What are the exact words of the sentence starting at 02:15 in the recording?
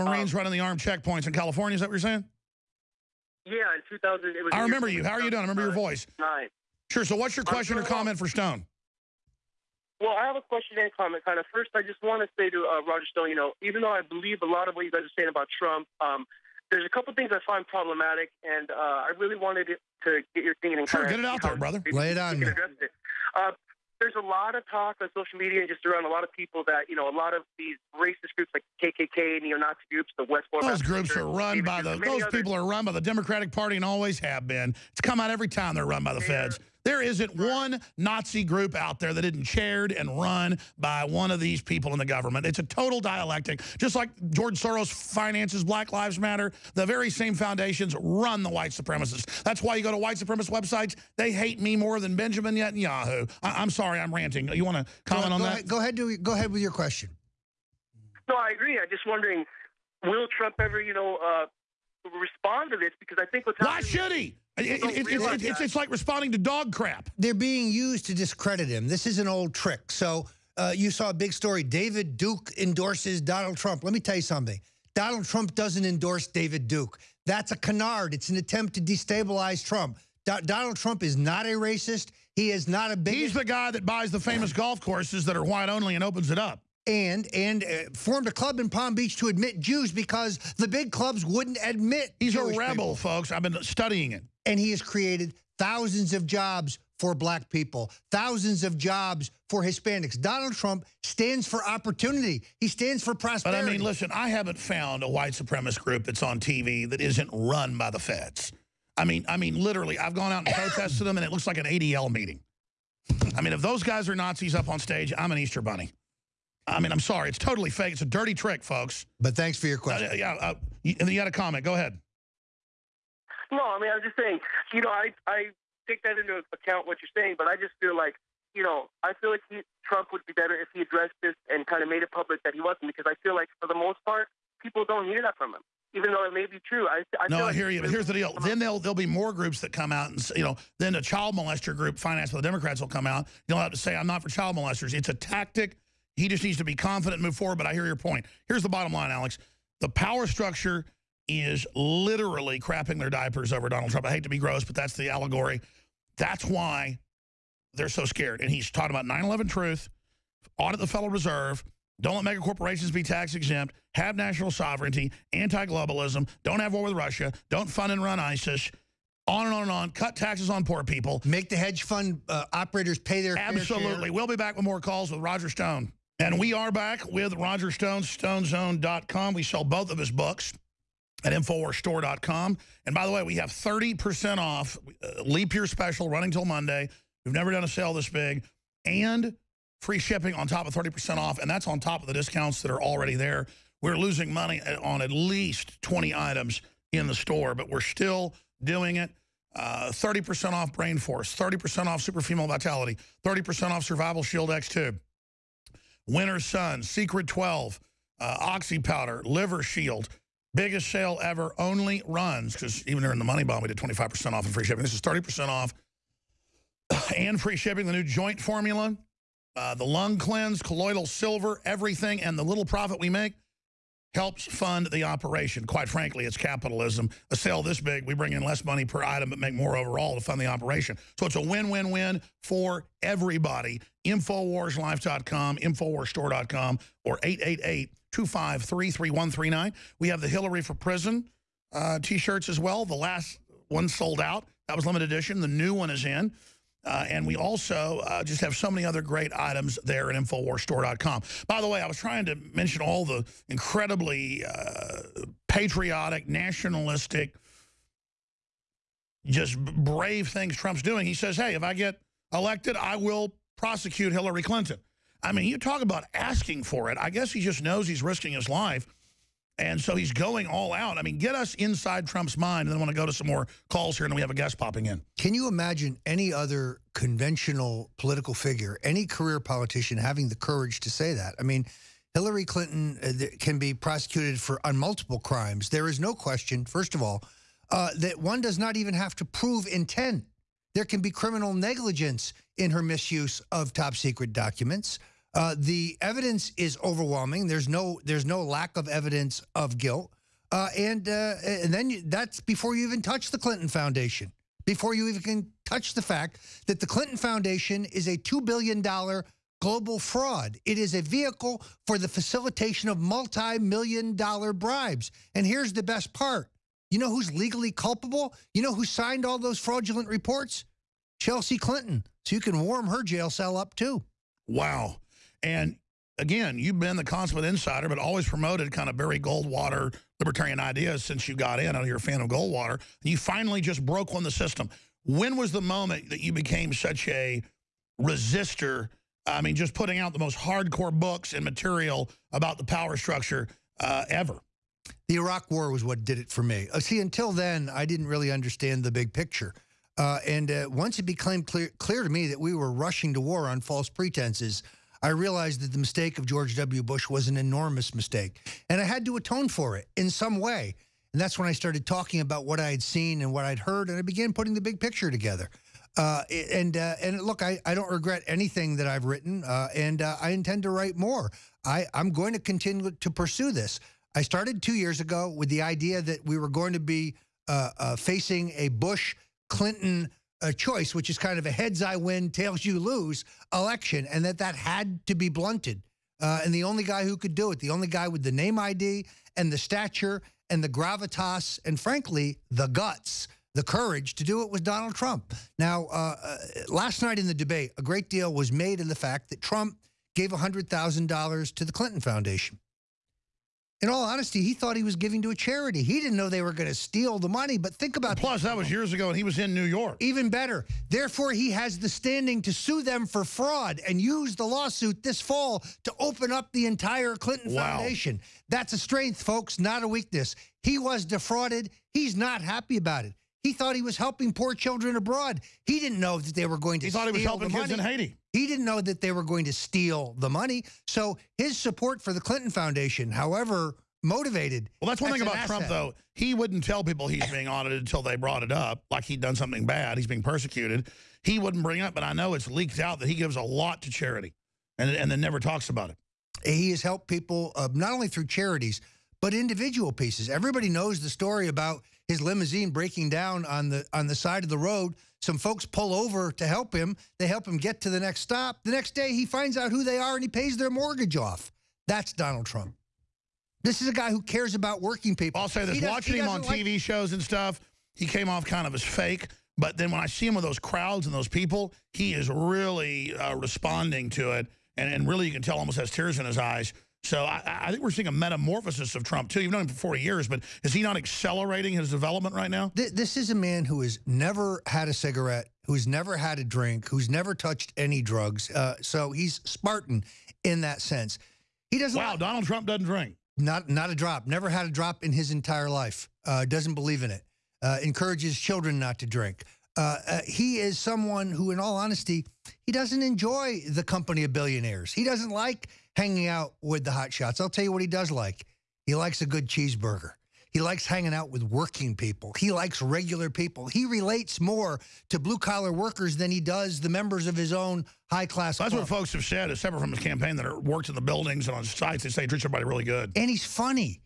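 Even though it may be true, I, I no, I like hear you.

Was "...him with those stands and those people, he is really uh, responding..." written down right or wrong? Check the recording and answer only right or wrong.
wrong.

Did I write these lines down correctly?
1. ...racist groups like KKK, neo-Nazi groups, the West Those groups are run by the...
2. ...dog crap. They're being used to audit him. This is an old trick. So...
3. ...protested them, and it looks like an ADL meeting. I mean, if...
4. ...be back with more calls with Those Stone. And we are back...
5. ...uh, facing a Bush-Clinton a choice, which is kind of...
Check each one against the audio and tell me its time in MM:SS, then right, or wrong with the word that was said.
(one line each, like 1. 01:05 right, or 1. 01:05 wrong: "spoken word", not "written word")
1. 00:27 right
2. 01:06 wrong: "discredit", not "audit"
3. 01:50 right
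4. 02:54 wrong: "Roger", not "Those"
5. 06:17 right.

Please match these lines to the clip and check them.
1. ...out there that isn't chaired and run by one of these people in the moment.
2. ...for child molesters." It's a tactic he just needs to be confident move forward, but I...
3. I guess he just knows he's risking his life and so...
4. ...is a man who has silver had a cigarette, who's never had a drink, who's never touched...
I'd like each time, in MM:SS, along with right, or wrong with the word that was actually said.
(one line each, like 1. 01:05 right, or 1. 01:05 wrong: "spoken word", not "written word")
1. 00:38 wrong: "government", not "moment"
2. 02:24 right
3. 04:26 right
4. 08:03 wrong: "never", not "silver".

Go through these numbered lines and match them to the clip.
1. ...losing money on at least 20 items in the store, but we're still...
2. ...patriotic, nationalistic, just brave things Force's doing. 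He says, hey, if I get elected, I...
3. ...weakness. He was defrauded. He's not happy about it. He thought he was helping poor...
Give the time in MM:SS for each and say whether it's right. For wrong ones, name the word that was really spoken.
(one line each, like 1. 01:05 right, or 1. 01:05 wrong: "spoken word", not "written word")
1. 03:13 right
2. 04:15 wrong: "Trump", not "Force"
3. 06:59 right.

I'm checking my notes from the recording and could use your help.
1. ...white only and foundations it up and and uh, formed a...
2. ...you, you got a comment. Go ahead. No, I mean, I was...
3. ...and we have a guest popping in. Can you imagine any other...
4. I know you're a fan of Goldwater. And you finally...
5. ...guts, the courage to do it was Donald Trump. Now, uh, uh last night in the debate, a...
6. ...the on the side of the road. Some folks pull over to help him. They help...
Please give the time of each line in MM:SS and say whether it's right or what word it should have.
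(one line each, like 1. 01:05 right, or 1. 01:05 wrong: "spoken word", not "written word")
1. 01:25 wrong: "opens", not "foundations"
2. 02:00 right
3. 04:34 right
4. 05:31 right
5. 06:32 right
6. 07:33 right.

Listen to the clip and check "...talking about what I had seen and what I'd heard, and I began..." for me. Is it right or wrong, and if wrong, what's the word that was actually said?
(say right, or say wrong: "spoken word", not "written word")
right.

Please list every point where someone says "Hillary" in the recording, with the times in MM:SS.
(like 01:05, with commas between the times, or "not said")
04:00, 04:24, 04:42.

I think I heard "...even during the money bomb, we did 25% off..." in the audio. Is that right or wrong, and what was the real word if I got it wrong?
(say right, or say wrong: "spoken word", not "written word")
right.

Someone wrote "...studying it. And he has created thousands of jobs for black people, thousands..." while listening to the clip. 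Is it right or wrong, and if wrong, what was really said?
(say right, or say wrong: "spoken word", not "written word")
right.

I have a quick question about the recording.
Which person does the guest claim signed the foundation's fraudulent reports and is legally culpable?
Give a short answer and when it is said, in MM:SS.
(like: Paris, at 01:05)
Chelsea Clinton, at 05:21.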